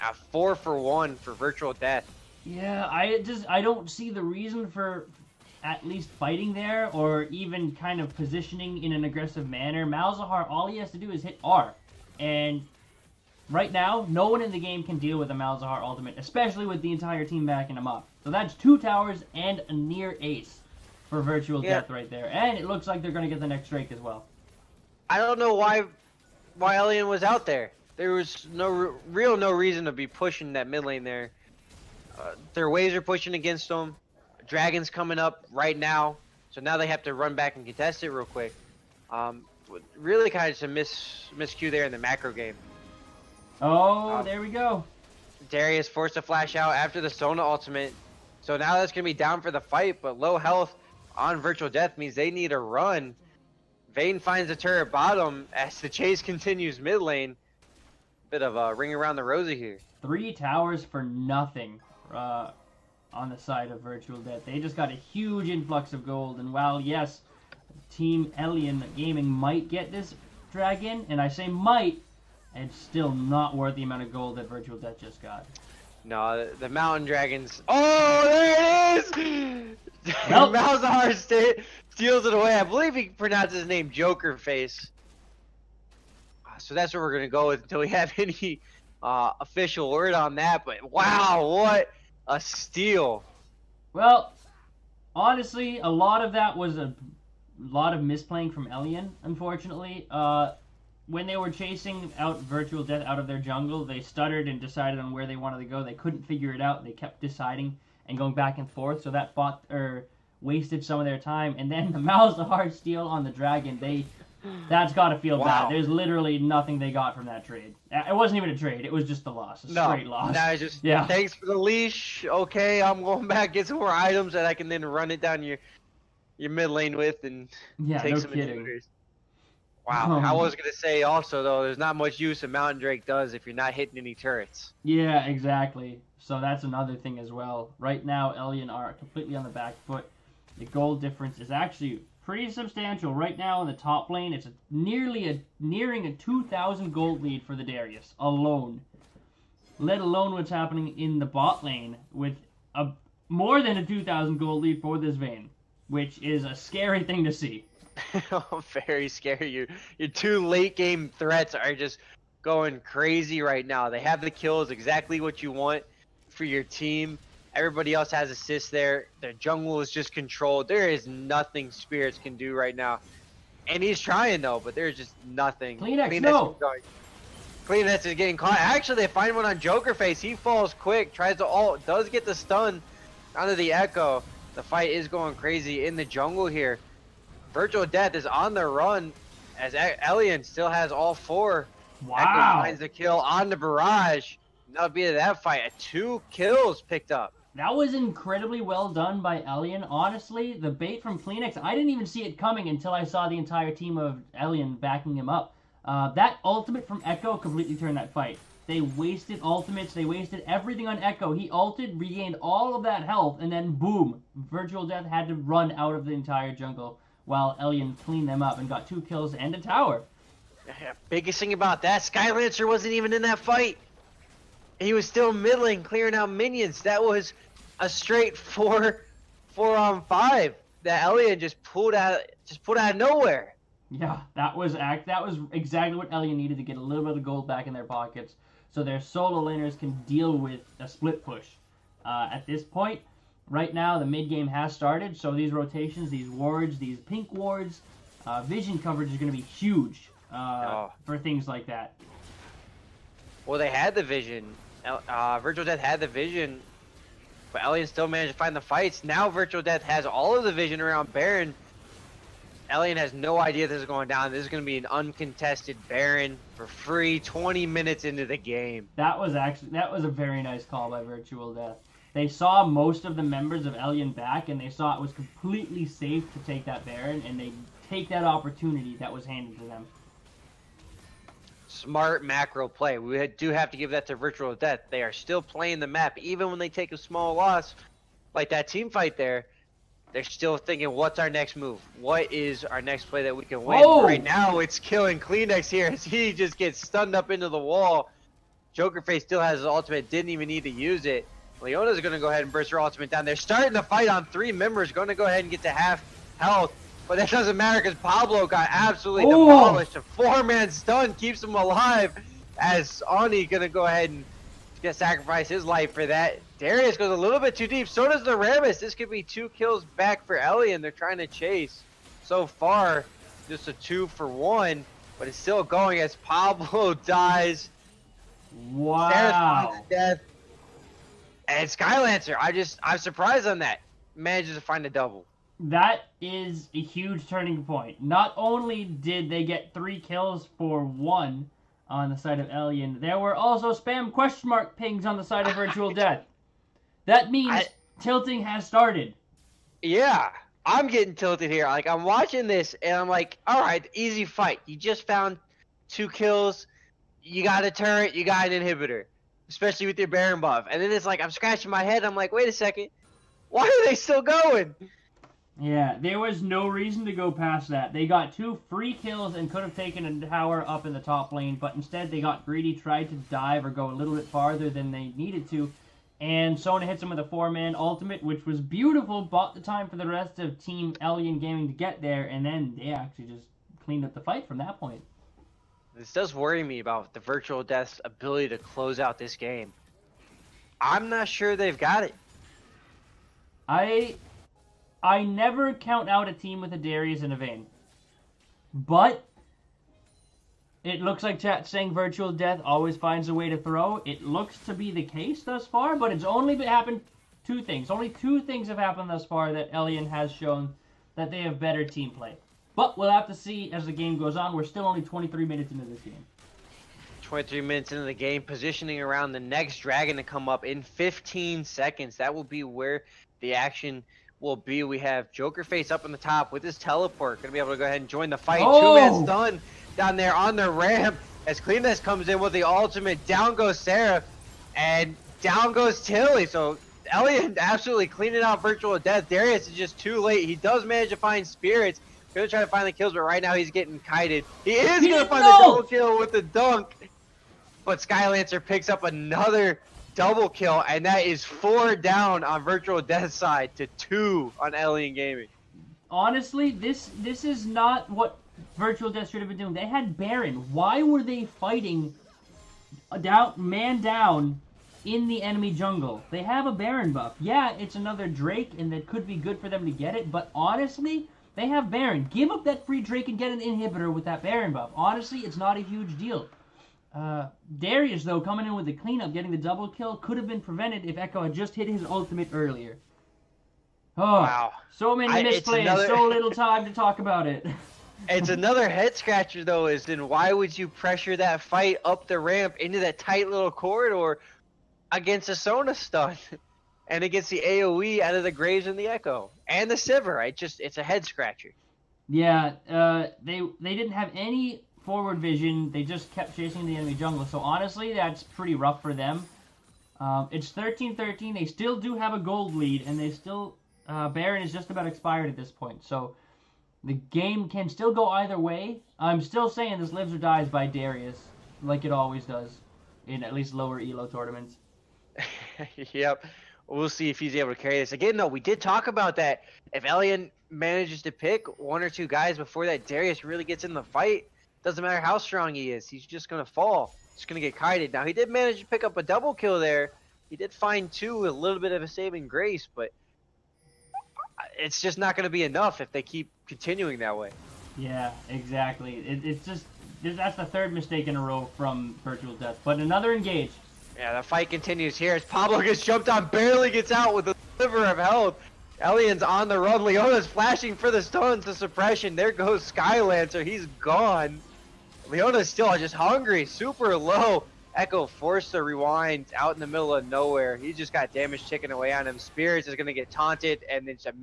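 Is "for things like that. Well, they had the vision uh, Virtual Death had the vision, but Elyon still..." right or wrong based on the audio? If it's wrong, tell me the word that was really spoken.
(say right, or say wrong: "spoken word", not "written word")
right.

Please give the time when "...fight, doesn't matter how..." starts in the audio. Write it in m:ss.
8:54.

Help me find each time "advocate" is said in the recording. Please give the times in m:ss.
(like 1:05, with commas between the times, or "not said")
not said.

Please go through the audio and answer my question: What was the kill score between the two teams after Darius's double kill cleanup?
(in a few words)
13-13.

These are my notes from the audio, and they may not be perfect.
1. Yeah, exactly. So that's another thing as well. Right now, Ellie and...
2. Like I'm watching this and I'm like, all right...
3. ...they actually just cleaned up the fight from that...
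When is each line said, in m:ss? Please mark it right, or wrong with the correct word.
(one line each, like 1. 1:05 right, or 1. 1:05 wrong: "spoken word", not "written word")
1. 2:14 right
2. 5:51 right
3. 6:22 right.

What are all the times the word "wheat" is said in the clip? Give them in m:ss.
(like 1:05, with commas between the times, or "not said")
not said.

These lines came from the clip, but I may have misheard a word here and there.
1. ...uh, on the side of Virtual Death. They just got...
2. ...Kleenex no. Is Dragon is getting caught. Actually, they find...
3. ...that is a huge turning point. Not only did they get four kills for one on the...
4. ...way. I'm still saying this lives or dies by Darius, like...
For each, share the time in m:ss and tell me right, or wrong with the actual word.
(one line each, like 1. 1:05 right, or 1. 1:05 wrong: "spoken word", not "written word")
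1. 1:02 right
2. 2:56 wrong: "Kleenex", not "Dragon"
3. 5:35 wrong: "three", not "four"
4. 8:38 right.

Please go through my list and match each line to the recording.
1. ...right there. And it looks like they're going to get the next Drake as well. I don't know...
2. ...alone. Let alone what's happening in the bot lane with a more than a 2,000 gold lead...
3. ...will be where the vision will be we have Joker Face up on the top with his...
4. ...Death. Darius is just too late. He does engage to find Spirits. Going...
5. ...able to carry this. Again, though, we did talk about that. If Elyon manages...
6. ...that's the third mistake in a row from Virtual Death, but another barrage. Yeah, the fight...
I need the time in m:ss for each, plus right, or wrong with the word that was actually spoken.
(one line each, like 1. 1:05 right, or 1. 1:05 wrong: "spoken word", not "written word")
1. 0:21 right
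2. 2:28 right
3. 7:02 wrong: "action", not "vision"
4. 7:18 wrong: "manage", not "engage"
5. 8:47 right
6. 9:10 wrong: "engage", not "barrage".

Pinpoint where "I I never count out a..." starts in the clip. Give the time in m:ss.
6:33.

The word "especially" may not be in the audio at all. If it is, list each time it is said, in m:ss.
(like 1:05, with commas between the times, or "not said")
0:16, 5:59.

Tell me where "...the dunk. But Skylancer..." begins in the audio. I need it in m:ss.
7:26.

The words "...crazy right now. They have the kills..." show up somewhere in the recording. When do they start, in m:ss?
2:42.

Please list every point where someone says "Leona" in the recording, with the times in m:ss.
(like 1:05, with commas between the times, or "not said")
5:01, 9:20, 9:25.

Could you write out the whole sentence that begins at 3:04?
The fight is going crazy in the jungle here.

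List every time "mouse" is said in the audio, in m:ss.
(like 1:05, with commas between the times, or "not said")
1:51.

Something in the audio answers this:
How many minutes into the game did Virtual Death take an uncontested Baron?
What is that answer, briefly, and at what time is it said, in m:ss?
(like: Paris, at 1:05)
20, at 4:27.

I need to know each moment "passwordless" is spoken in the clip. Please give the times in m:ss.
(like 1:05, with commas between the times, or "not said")
not said.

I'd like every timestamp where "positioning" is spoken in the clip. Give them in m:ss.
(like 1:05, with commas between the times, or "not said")
0:08, 6:58.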